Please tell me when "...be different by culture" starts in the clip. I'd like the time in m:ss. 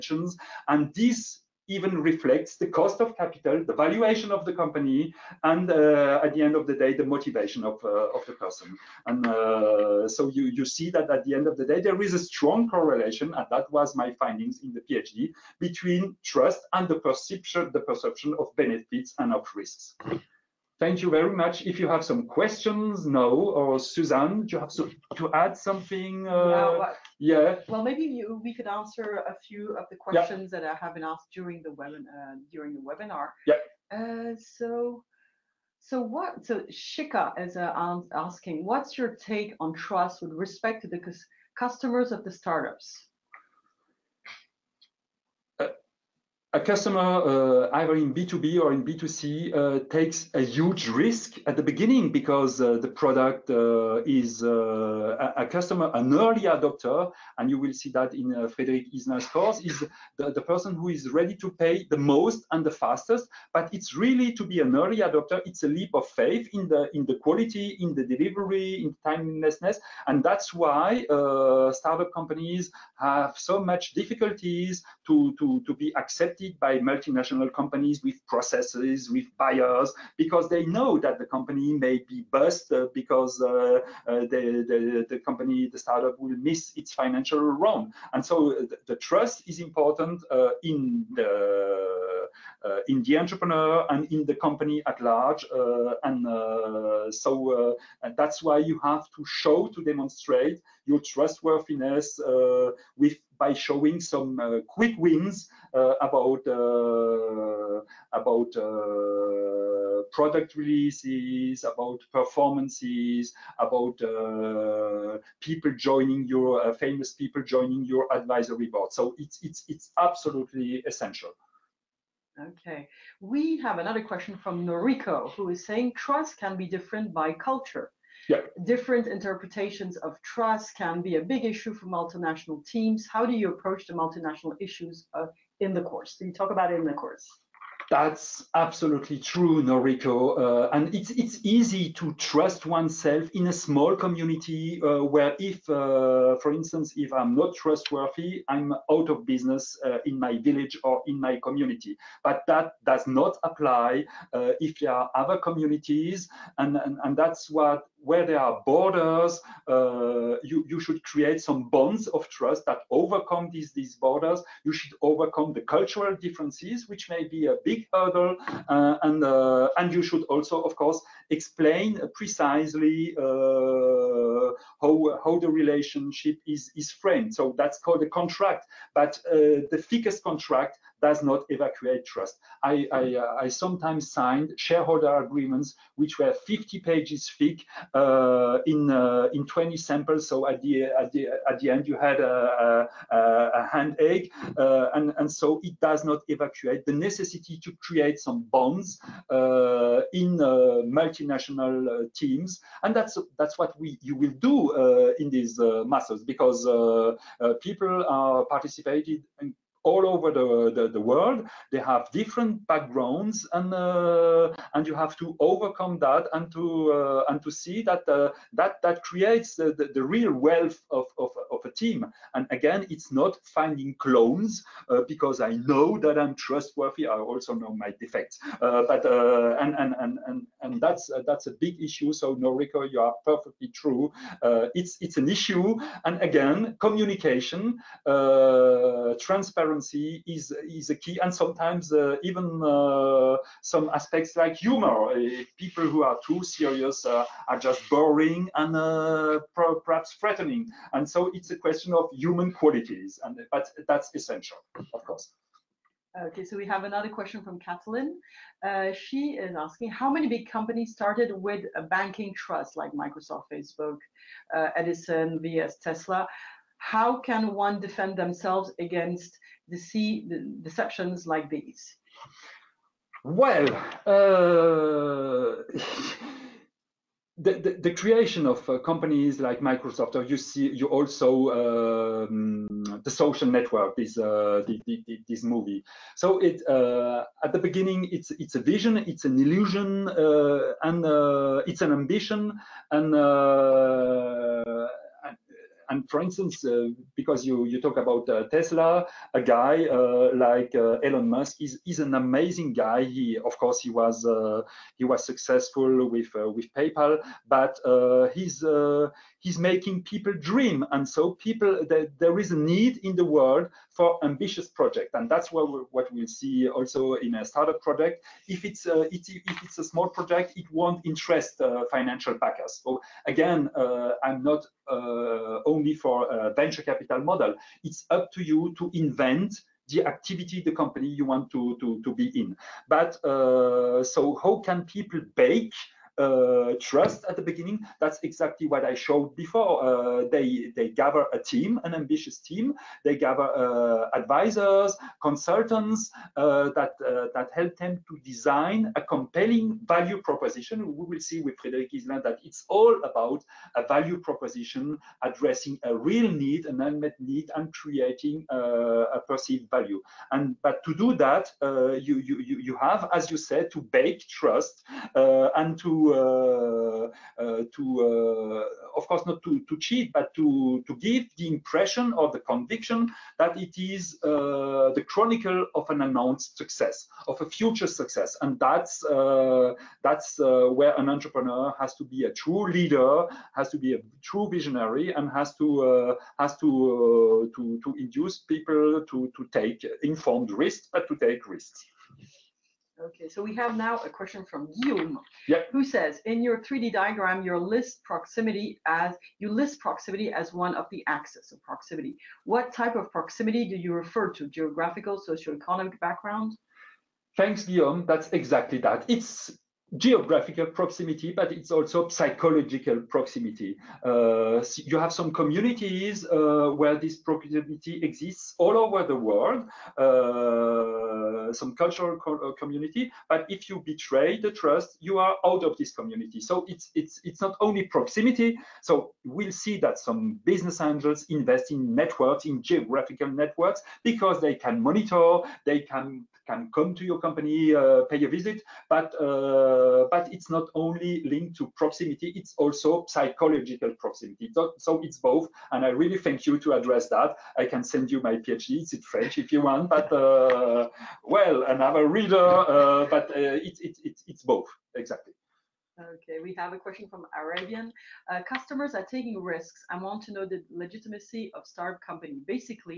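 2:06.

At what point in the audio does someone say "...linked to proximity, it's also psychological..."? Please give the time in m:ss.
7:21.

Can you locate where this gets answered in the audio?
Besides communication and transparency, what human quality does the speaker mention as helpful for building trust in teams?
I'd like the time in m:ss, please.
4:04.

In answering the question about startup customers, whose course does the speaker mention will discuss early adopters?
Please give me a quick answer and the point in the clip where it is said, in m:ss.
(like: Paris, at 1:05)
Frederick Iselin, at 0:58.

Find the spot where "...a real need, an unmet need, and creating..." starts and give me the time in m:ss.
5:55.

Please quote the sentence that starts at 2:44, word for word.
You should overcome the cultural differences, which may be a big hurdle.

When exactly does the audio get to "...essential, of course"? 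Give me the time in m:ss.
4:14.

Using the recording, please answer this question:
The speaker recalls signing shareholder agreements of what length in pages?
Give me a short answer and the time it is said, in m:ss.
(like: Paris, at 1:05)
50, at 3:06.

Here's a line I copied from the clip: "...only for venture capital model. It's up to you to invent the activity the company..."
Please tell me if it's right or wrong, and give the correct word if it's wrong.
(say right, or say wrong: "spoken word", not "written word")
right.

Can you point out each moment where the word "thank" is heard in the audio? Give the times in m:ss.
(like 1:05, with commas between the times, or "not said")
0:20, 6:47, 7:26.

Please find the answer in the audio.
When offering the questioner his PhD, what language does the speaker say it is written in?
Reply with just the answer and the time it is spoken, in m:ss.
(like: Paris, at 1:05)
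French, at 7:29.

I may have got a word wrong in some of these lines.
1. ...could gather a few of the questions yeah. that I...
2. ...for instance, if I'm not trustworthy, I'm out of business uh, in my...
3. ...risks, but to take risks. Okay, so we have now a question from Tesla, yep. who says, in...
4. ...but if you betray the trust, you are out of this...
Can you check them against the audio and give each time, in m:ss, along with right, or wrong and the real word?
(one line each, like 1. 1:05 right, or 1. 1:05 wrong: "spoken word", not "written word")
1. 0:28 wrong: "answer", not "gather"
2. 2:26 right
3. 6:30 wrong: "Guillaume", not "Tesla"
4. 7:03 right.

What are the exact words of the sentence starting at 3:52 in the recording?
So Noriko, you are perfectly true.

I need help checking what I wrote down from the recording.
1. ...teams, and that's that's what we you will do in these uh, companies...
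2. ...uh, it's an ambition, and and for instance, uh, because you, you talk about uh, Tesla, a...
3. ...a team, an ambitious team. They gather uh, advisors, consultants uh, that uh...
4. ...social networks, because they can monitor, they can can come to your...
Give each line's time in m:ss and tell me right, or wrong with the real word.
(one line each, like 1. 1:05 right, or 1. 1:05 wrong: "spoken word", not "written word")
1. 3:22 wrong: "muscles", not "companies"
2. 4:51 right
3. 5:41 right
4. 7:12 wrong: "geographical", not "social".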